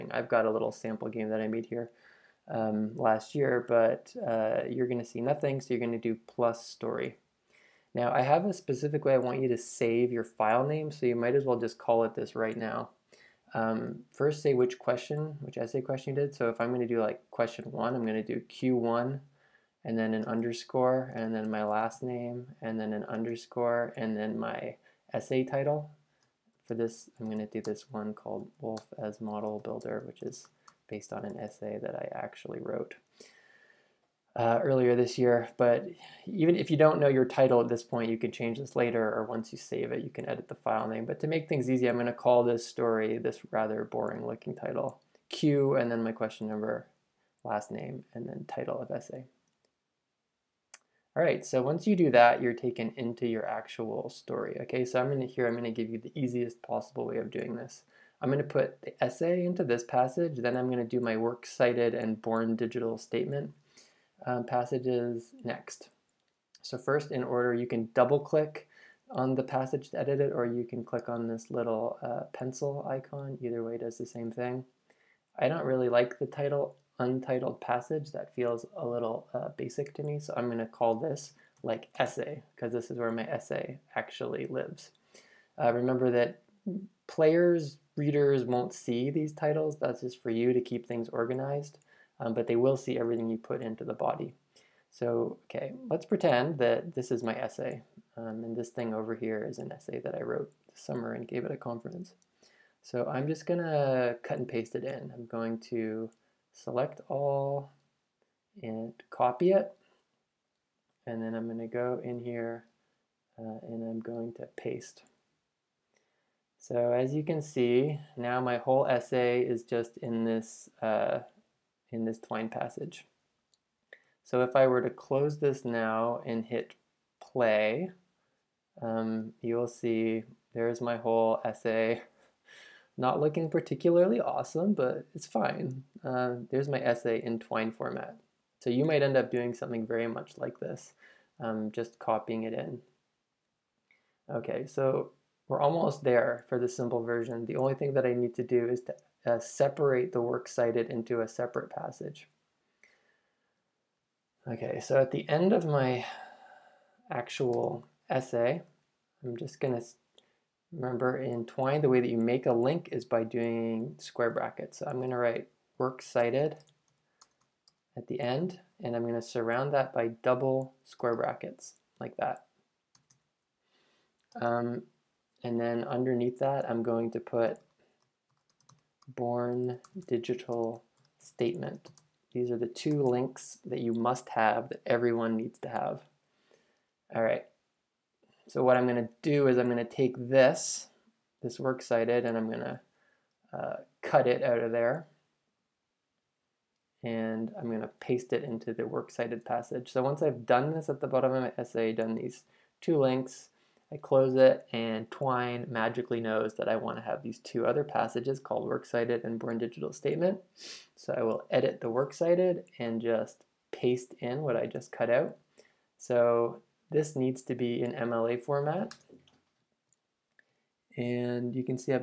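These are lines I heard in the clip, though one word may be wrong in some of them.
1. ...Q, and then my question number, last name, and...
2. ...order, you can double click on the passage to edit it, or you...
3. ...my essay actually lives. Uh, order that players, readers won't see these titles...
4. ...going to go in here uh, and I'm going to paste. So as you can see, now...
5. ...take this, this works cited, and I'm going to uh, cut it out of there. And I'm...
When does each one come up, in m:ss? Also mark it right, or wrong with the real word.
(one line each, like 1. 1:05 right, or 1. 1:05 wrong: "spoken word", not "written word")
1. 0:45 right
2. 1:07 right
3. 1:23 wrong: "remember", not "order"
4. 1:51 right
5. 3:09 right.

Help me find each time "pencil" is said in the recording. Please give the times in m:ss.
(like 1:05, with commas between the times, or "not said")
1:12.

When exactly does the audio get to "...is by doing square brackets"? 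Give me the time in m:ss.
2:42.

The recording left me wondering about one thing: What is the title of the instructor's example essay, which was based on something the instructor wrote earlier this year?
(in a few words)
Woolf as Model Builder.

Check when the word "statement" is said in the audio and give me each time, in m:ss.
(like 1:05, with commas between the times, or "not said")
1:02, 3:01, 3:29.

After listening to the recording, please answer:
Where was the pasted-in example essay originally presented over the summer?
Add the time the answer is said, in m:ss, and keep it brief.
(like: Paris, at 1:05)
a conference, at 1:41.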